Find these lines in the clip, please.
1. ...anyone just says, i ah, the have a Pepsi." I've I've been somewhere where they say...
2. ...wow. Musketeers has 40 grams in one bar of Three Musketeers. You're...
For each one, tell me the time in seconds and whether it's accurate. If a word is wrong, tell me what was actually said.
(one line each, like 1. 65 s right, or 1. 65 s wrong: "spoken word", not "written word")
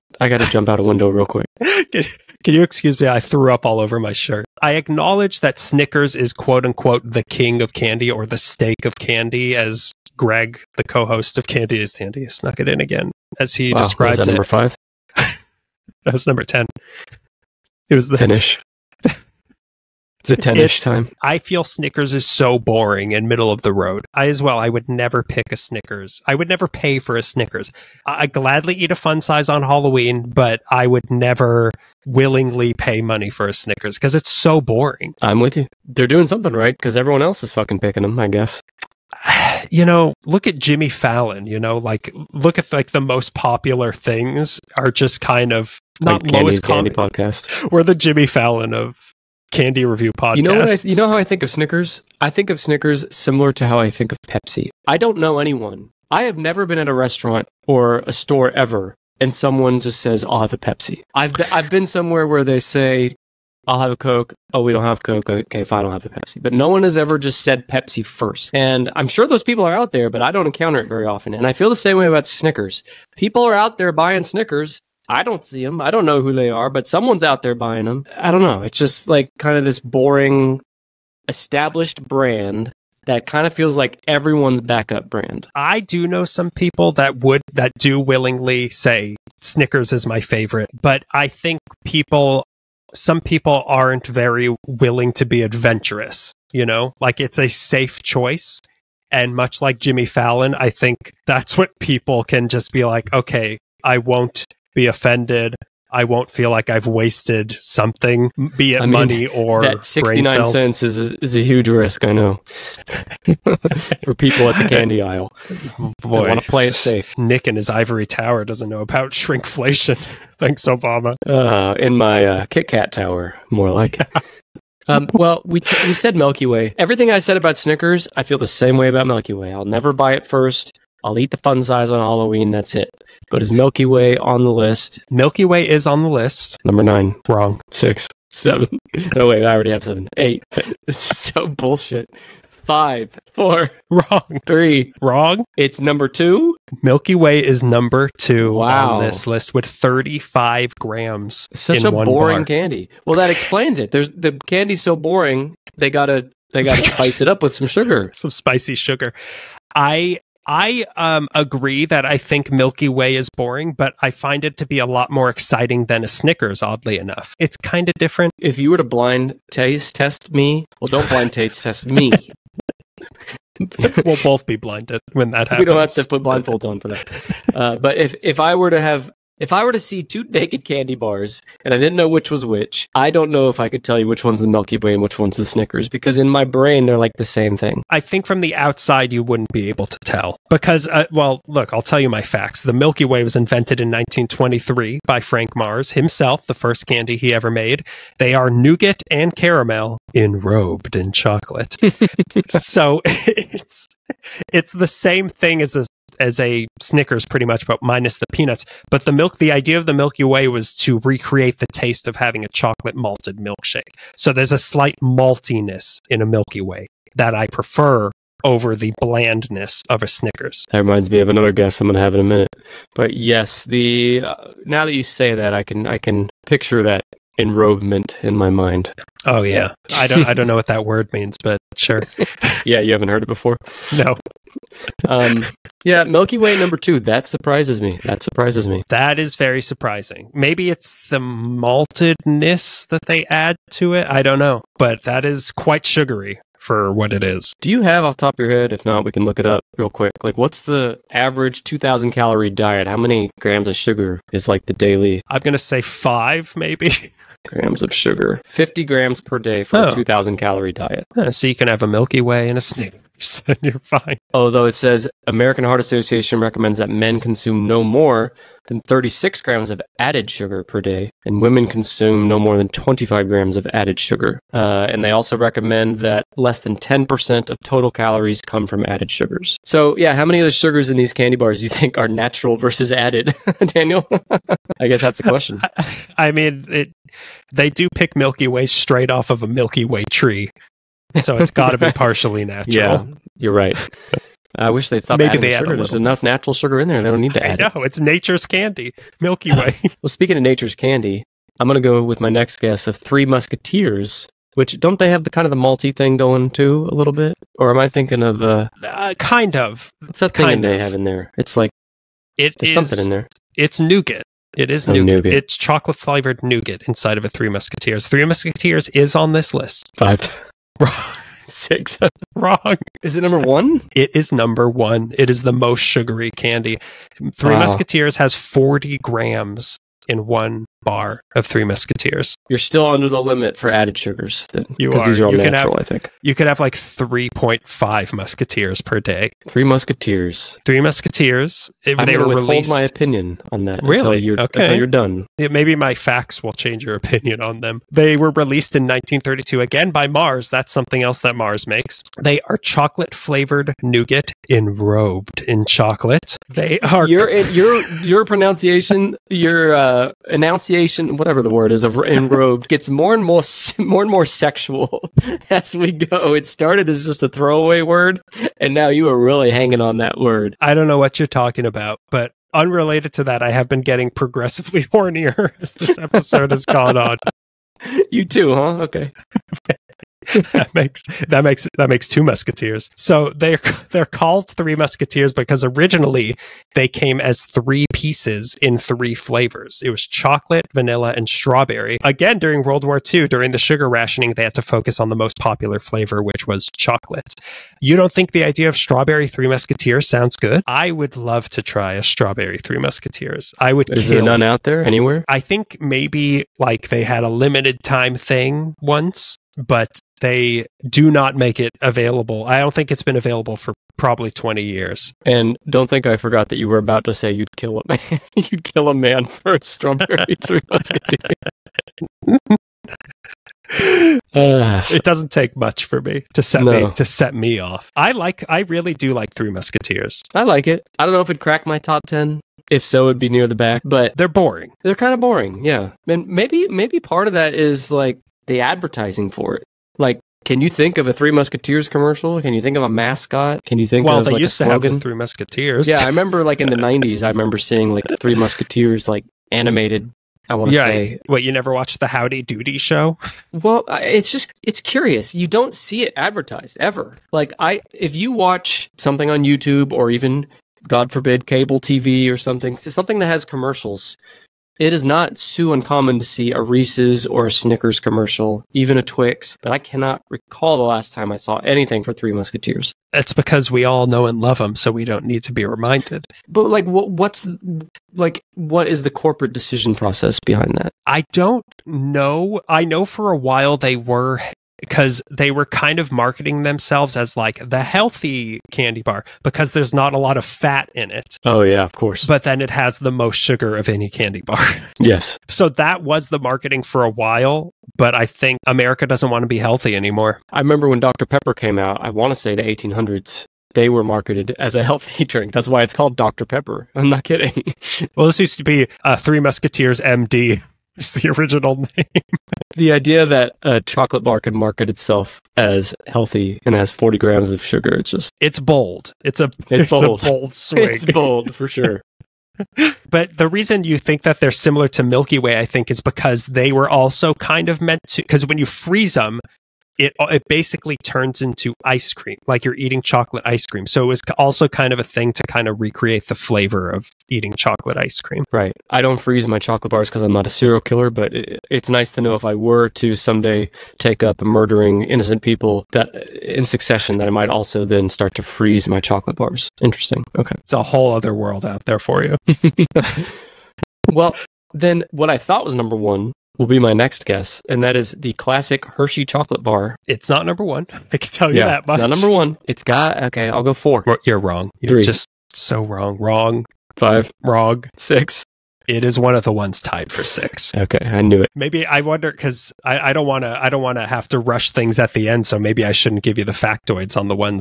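1. 59 s wrong: "someone", not "anyone"
2. 327 s right.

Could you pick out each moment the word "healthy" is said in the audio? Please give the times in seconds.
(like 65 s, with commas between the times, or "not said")
487 s, 499 s, 504 s, 516 s.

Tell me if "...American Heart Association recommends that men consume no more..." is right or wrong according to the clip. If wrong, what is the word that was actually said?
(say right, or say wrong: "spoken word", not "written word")
right.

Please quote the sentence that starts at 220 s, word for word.
That reminds me of another guess I'm going to have in a minute.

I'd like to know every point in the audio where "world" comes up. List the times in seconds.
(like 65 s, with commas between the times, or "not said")
392 s, 551 s.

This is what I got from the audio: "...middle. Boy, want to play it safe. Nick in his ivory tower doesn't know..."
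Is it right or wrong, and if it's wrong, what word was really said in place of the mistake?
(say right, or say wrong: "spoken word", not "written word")
wrong: "aisle", not "middle".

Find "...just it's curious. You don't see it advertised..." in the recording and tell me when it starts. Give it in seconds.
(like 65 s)
454 s.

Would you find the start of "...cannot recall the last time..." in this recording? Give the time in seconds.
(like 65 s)
469 s.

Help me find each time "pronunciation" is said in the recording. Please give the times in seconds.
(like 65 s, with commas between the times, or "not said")
358 s.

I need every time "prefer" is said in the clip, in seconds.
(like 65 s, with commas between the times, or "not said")
217 s.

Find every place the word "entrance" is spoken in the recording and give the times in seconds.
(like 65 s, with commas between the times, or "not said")
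not said.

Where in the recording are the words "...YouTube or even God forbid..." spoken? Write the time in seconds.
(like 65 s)
459 s.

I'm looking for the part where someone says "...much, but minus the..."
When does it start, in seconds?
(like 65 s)
207 s.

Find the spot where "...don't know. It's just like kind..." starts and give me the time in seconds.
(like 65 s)
78 s.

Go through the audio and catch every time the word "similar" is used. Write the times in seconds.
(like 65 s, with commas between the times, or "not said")
53 s, 524 s.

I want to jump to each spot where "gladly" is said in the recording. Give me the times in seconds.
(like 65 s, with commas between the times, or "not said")
28 s.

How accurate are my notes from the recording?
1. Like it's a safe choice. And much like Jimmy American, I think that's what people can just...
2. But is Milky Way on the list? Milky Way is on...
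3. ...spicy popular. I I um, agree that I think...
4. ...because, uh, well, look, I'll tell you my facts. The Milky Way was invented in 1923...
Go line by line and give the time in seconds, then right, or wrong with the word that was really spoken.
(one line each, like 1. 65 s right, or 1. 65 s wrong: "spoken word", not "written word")
1. 96 s wrong: "Fallon", not "American"
2. 133 s right
3. 158 s wrong: "sugar", not "popular"
4. 190 s right.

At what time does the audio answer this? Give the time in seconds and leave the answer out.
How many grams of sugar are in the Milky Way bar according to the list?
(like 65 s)
149 s.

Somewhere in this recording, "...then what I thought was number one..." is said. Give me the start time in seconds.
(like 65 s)
554 s.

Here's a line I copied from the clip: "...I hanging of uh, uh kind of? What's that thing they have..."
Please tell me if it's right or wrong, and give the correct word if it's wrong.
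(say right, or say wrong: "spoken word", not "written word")
wrong: "thinking", not "hanging".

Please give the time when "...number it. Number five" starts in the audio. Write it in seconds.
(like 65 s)
14 s.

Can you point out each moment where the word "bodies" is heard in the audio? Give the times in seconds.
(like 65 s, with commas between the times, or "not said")
not said.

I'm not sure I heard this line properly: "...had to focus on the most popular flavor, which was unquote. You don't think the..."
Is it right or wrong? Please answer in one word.
wrong.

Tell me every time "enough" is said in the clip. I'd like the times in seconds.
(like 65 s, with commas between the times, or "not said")
166 s, 295 s.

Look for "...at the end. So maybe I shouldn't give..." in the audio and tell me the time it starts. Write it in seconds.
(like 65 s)
574 s.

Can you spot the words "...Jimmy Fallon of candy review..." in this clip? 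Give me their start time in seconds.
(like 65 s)
47 s.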